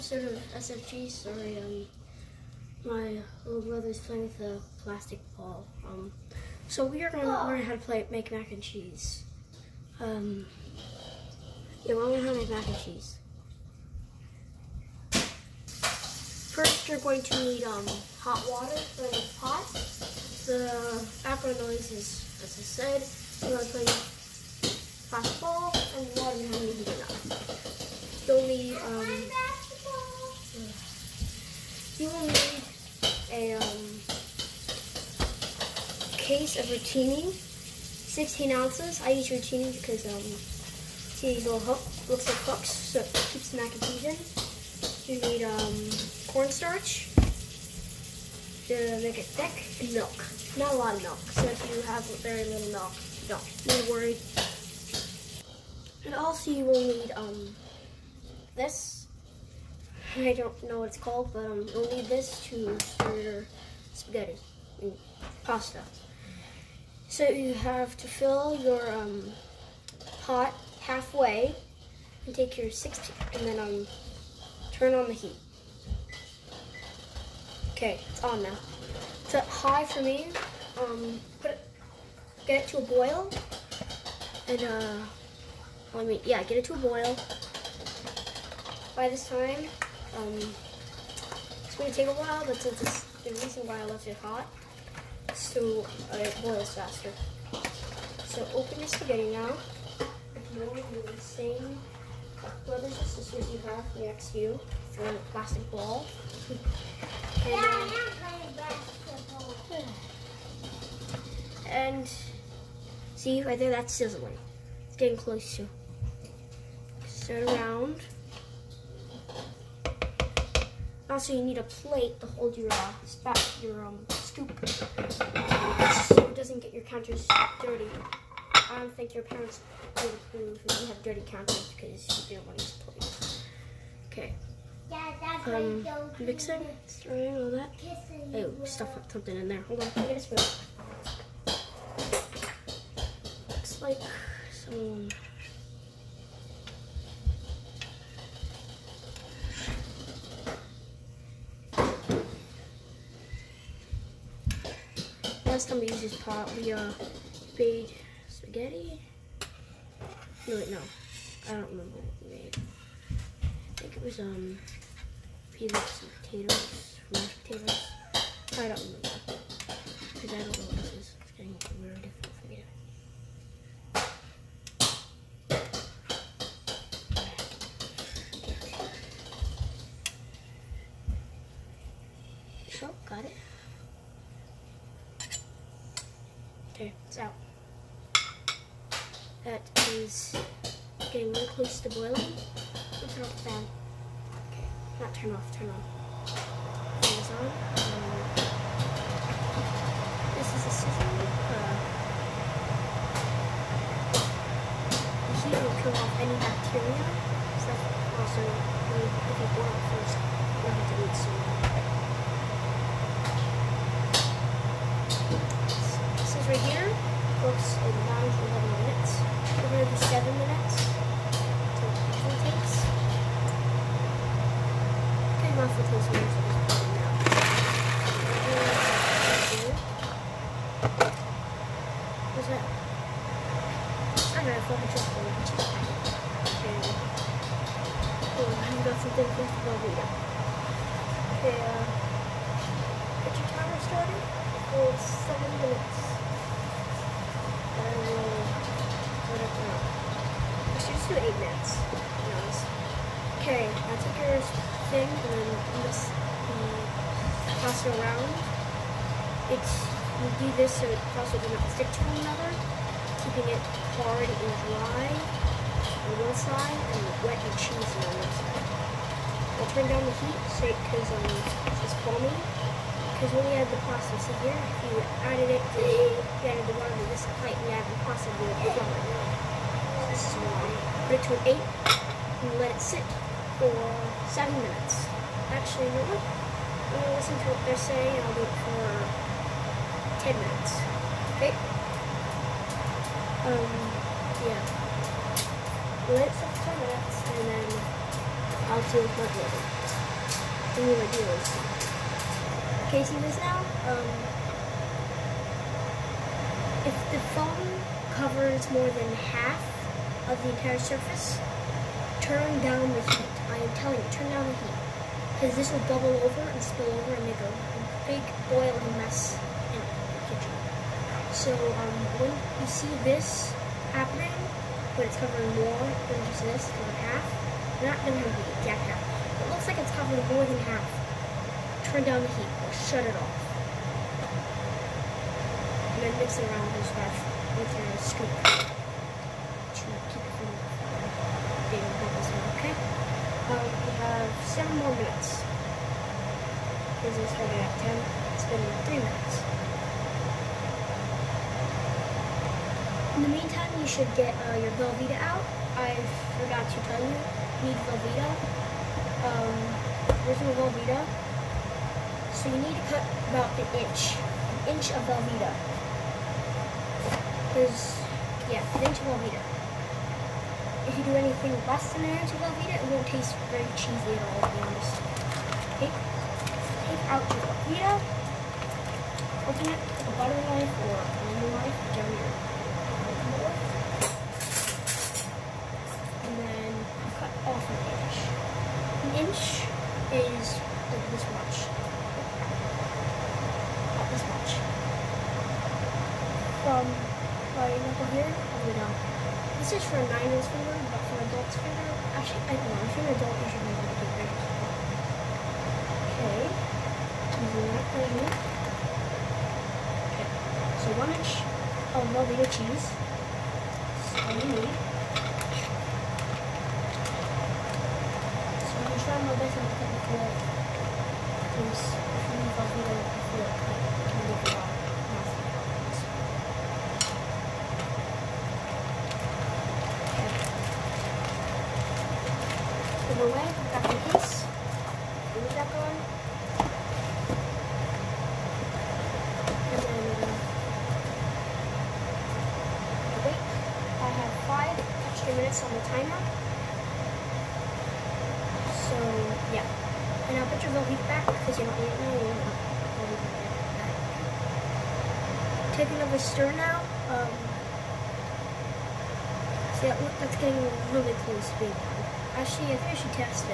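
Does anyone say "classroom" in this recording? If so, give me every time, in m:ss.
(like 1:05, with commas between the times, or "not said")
not said.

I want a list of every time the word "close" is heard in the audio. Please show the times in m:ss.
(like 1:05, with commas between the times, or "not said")
1:55, 3:11, 7:41.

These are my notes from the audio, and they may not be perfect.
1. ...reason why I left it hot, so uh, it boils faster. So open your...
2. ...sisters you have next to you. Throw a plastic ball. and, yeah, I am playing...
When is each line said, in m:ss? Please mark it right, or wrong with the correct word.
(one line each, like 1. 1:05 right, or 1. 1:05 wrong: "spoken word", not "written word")
1. 1:33 right
2. 1:43 right.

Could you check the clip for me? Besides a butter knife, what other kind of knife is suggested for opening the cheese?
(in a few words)
lemon knife.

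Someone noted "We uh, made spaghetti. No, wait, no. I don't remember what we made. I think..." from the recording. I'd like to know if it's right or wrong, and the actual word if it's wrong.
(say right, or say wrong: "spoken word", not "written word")
right.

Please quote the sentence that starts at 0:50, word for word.
Not a lot of milk, so if you have very little milk, don't be worried.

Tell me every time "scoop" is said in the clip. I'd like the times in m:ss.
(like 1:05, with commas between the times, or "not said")
2:04, 5:37.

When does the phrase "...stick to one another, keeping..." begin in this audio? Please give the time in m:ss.
4:21.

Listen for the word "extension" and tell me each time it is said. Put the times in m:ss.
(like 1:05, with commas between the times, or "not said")
not said.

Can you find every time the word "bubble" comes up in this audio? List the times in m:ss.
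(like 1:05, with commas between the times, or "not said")
5:15, 5:41.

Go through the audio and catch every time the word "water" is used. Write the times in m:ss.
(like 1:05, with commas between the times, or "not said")
0:18, 0:26, 4:36.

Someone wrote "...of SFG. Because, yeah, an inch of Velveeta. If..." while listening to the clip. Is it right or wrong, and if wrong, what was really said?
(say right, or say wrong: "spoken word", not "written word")
wrong: "Velveeta", not "SFG".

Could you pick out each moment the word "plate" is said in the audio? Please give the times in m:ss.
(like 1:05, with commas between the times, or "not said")
2:01, 2:12.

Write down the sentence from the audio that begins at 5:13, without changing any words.
I am telling you, turn down the heat.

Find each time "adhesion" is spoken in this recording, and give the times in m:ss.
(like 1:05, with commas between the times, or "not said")
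0:43.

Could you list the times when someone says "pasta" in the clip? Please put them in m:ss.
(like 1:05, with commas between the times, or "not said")
1:05, 4:33, 4:38.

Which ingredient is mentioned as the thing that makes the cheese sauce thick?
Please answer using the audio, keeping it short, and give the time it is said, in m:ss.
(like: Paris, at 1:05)
cornstarch, at 0:46.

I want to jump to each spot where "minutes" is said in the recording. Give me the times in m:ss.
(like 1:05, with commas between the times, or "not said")
4:11, 4:44, 4:50, 4:56, 5:45, 5:49, 7:25.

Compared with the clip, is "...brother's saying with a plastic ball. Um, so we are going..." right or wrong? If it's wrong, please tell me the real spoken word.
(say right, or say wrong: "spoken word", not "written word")
wrong: "playing", not "saying".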